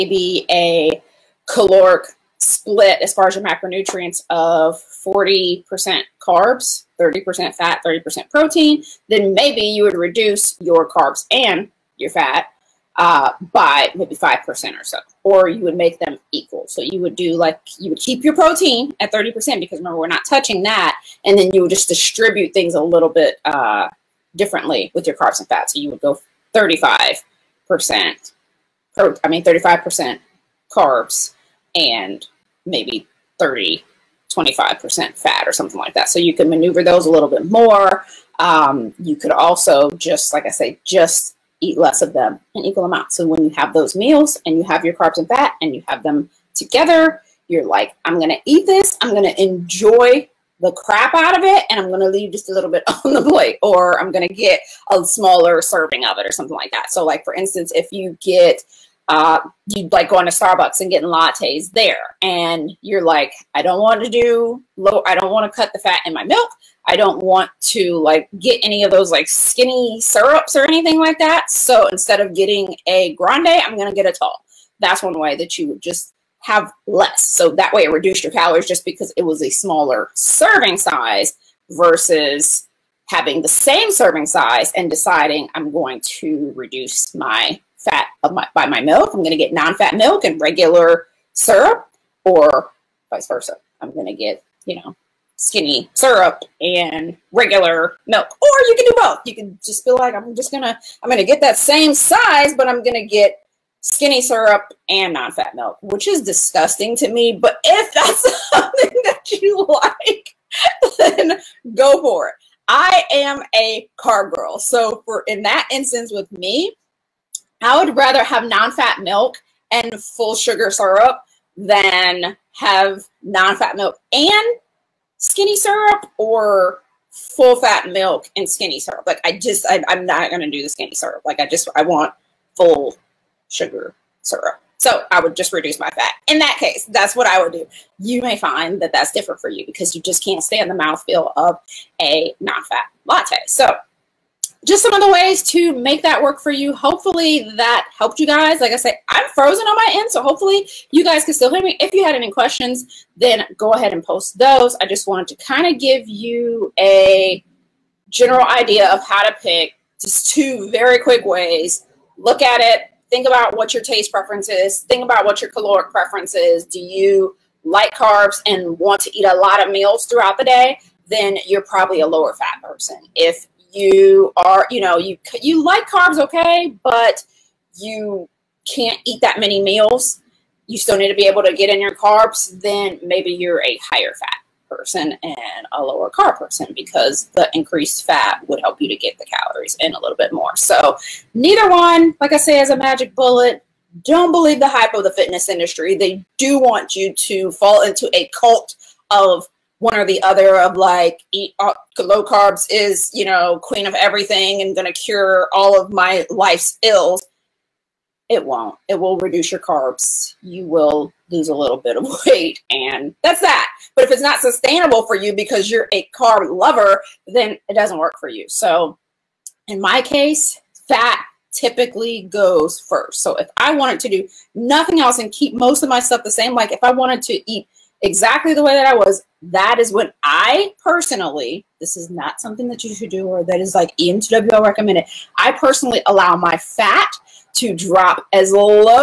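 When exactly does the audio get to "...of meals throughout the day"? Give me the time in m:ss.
2:49.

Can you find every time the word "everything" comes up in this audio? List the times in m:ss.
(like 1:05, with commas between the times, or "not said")
3:23.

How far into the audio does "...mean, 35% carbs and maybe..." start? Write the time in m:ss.
0:29.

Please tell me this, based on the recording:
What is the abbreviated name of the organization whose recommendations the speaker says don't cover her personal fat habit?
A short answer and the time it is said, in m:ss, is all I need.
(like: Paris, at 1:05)
EM2WL, at 3:53.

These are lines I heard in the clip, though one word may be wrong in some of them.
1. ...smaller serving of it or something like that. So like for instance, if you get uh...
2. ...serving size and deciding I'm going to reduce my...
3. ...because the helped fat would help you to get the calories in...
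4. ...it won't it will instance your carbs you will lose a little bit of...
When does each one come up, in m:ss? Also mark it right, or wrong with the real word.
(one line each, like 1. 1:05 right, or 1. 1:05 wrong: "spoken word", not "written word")
1. 0:55 right
2. 1:23 right
3. 3:06 wrong: "increased", not "helped"
4. 3:28 wrong: "reduce", not "instance".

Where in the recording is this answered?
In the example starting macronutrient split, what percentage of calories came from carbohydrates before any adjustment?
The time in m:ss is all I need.
0:04.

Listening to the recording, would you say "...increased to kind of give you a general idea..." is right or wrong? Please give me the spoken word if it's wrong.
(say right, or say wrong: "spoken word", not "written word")
wrong: "wanted", not "increased".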